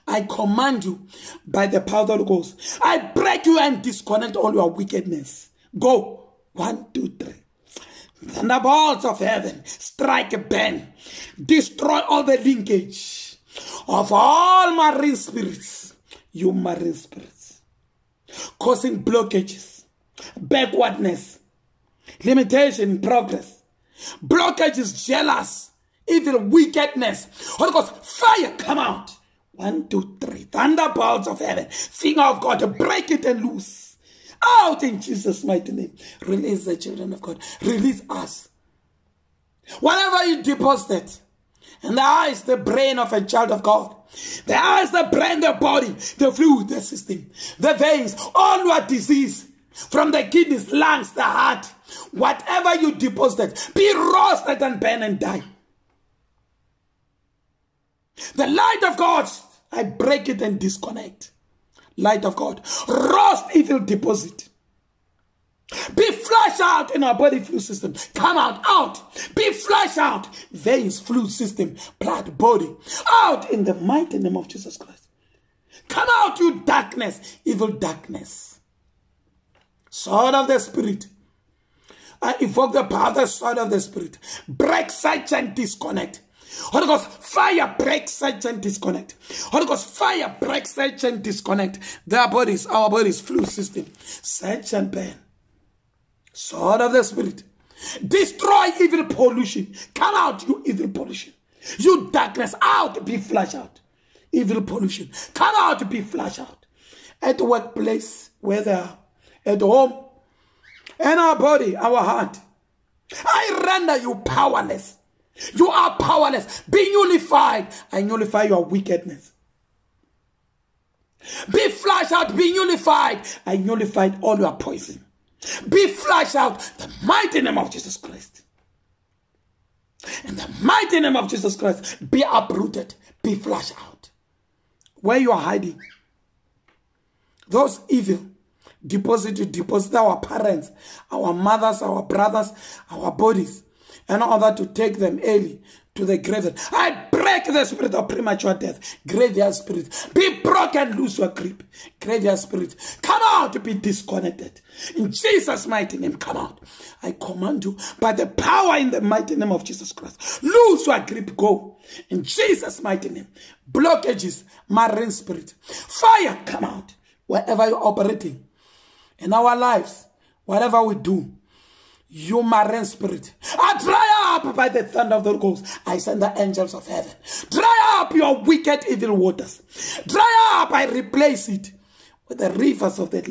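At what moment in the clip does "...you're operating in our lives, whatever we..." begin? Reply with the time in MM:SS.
02:47.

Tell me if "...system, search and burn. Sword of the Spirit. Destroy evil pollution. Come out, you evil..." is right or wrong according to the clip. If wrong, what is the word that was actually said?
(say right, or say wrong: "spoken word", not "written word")
right.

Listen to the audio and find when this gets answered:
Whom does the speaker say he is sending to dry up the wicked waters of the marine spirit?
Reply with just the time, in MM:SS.
02:56.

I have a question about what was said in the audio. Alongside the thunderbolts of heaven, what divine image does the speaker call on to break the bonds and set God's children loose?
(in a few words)
Finger of God.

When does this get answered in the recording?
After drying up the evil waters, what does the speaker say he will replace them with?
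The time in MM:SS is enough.
03:02.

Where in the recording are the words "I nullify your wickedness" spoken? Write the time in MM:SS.
01:57.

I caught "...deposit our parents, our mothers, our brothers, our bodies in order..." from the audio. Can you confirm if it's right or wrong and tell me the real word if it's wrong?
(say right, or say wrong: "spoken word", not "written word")
right.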